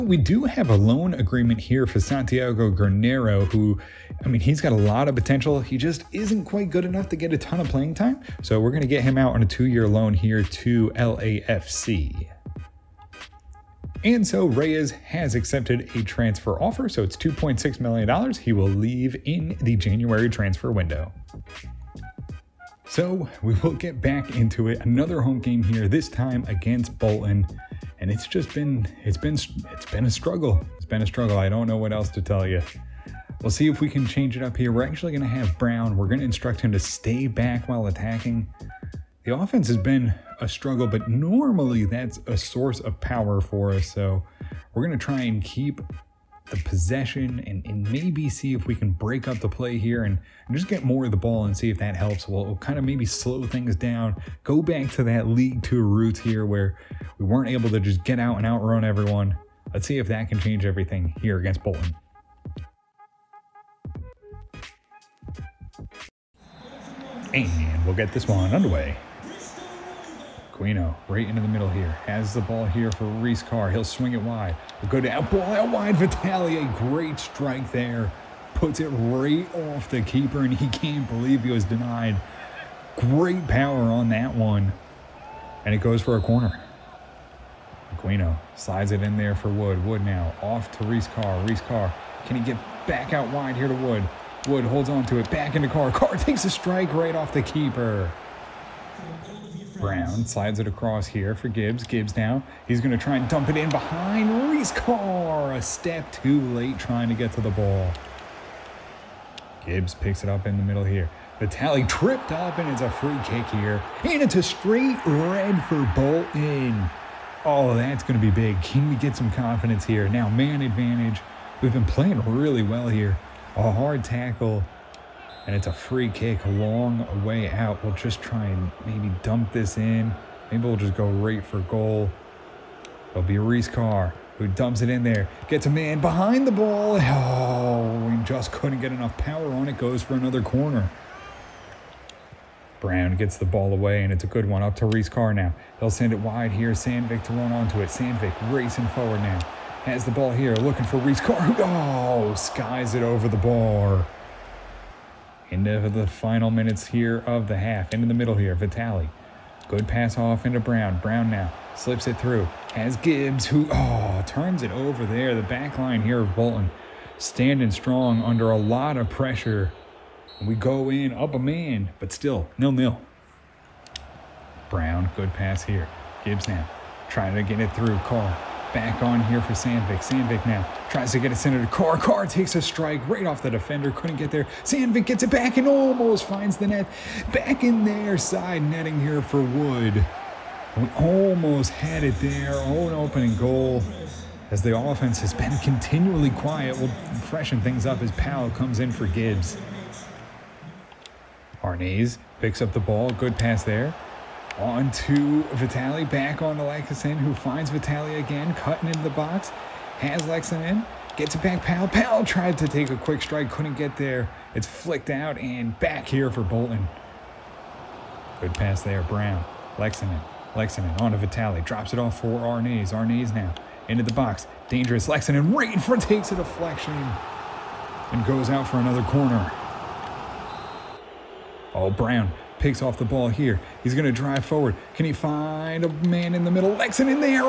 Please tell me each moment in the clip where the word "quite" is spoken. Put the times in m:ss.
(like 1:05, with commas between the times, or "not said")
0:06.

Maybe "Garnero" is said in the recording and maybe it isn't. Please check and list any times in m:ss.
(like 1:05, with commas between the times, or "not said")
0:02.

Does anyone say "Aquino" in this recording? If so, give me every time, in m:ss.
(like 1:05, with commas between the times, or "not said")
1:10, 1:27.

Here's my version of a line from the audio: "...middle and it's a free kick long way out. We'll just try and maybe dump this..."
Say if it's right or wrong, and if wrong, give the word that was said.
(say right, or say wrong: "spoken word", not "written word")
wrong: "tackle", not "middle".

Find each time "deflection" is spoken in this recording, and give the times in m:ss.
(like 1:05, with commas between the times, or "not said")
3:46.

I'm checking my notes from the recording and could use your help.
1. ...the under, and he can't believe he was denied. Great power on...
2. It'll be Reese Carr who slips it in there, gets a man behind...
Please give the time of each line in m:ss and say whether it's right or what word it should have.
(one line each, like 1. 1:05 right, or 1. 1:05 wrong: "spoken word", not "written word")
1. 1:19 wrong: "keeper", not "under"
2. 2:13 wrong: "dumps", not "slips".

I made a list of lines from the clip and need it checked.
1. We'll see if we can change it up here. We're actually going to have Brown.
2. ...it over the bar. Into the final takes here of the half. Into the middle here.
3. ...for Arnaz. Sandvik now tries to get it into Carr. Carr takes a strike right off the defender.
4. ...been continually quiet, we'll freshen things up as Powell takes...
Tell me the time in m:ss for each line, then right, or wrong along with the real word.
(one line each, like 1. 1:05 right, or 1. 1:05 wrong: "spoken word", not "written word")
1. 0:33 right
2. 2:32 wrong: "minutes", not "takes"
3. 2:59 wrong: "Sandvik", not "Arnaz"
4. 3:15 wrong: "comes", not "takes".